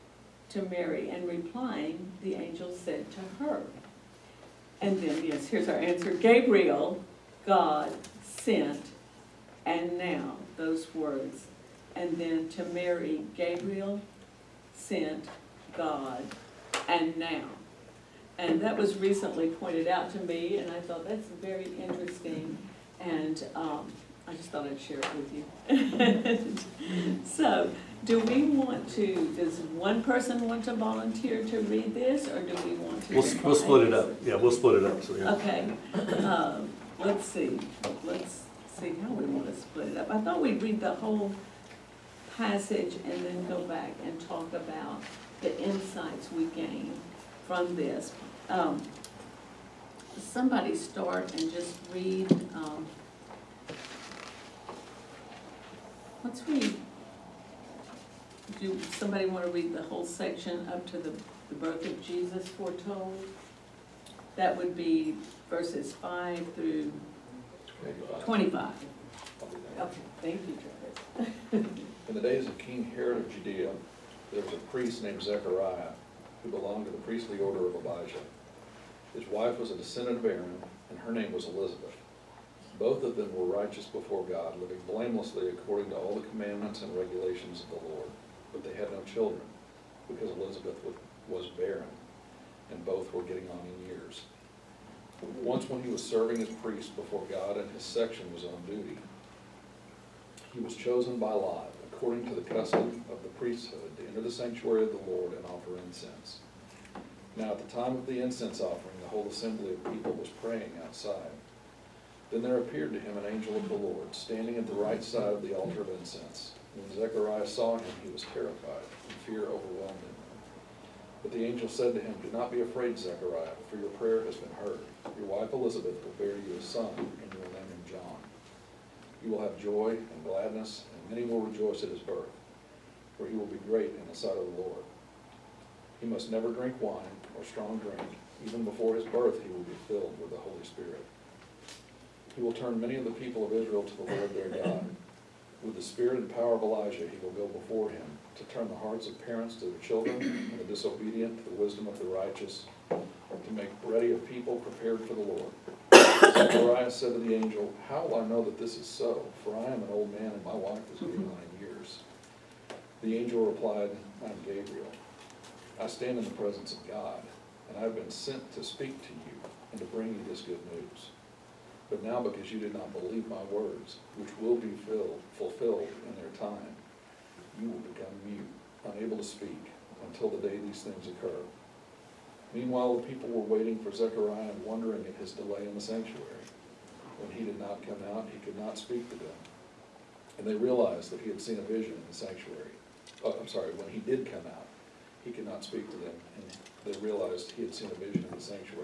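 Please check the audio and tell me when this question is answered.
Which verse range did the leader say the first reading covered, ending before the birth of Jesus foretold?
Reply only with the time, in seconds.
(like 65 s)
65 s.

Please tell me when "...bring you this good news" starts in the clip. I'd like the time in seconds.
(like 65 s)
169 s.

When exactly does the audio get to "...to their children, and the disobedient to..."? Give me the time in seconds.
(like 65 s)
149 s.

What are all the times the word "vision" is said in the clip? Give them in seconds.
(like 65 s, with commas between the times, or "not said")
191 s, 197 s.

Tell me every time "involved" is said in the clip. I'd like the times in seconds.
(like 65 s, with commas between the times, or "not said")
not said.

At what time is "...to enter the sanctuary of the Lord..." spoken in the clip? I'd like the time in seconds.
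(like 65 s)
103 s.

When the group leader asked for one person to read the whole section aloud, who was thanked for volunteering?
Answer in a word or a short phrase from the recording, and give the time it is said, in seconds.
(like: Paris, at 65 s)
Travis, at 70 s.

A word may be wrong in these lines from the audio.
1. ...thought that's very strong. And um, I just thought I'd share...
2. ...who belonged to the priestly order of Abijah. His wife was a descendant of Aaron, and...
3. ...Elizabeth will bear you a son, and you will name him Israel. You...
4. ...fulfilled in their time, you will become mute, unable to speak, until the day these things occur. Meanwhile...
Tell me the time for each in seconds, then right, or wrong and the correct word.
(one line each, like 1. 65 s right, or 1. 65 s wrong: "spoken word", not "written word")
1. 20 s wrong: "interesting", not "strong"
2. 76 s right
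3. 125 s wrong: "John", not "Israel"
4. 175 s right.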